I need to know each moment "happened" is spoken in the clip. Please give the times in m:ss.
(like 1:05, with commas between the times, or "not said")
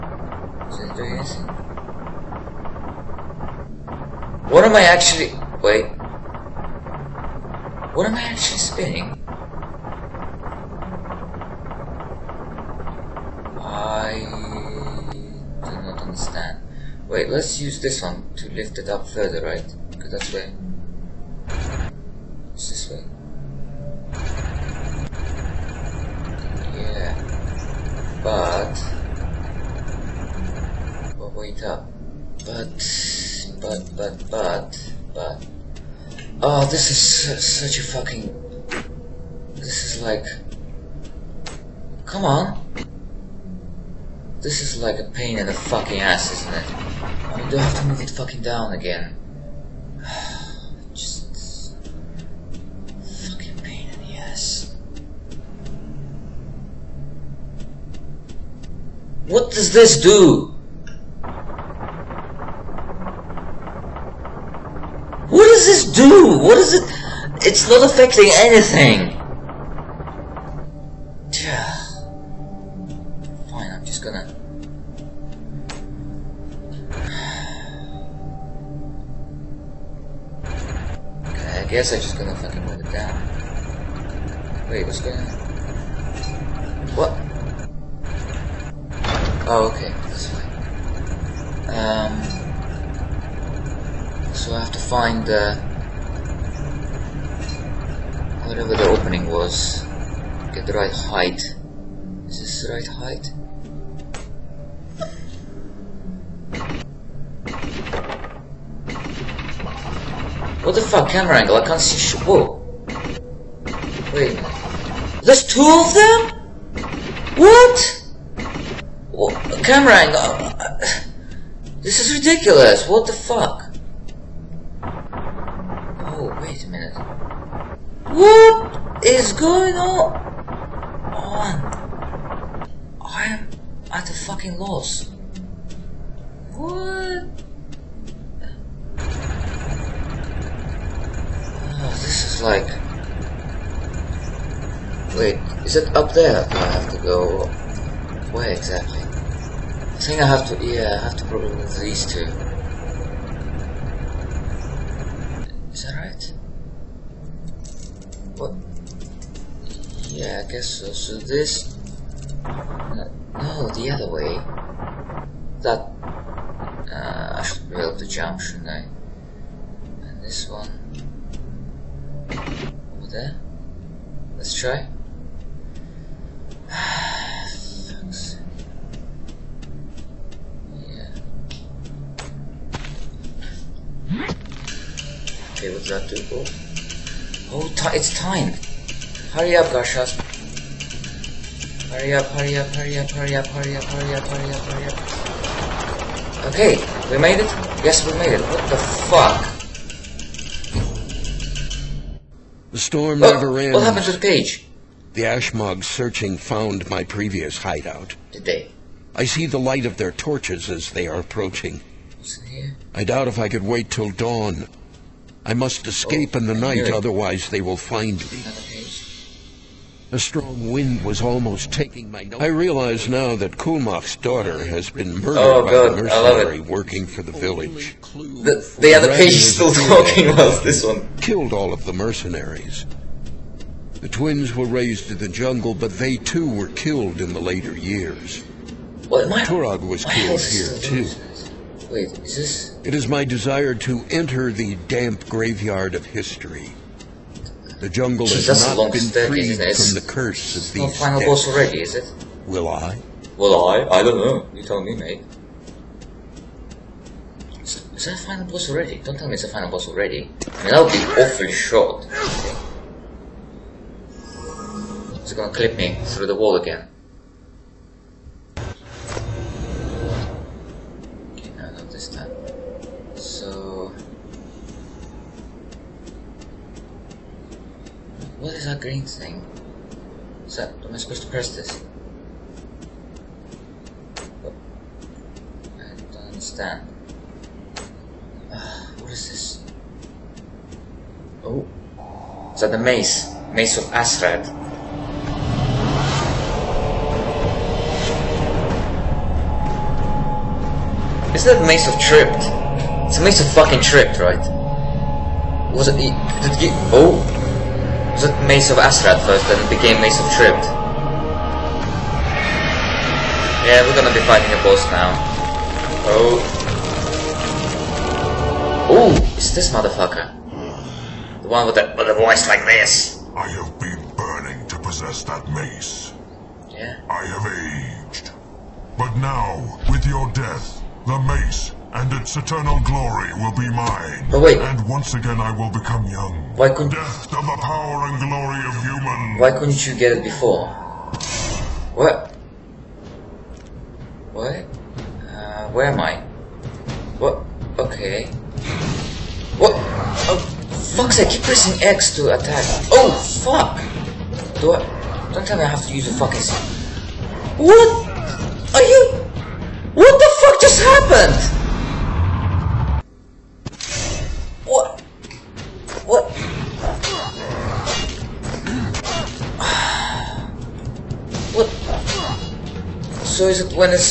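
3:23, 6:00.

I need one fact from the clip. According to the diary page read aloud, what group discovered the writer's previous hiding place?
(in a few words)
The Ashmogs.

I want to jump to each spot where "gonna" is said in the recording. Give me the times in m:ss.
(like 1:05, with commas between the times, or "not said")
4:25, 5:13.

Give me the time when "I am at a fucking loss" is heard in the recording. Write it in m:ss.
2:13.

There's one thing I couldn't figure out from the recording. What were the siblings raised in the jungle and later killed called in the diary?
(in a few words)
The twins.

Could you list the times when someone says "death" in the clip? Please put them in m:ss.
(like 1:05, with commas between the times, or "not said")
5:30, 5:36.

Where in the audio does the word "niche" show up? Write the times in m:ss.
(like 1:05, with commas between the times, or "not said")
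not said.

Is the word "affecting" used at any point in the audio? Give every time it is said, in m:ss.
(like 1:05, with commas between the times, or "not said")
1:07.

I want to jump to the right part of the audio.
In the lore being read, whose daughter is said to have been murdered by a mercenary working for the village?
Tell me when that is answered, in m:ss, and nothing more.
3:43.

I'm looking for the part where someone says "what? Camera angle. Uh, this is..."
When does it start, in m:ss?
1:59.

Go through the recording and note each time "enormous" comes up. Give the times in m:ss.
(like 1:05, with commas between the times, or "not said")
not said.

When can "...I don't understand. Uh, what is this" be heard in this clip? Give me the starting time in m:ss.
4:45.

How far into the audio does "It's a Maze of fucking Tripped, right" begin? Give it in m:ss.
5:03.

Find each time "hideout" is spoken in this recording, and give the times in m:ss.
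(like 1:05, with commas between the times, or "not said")
3:27.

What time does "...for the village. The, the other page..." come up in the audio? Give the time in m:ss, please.
3:47.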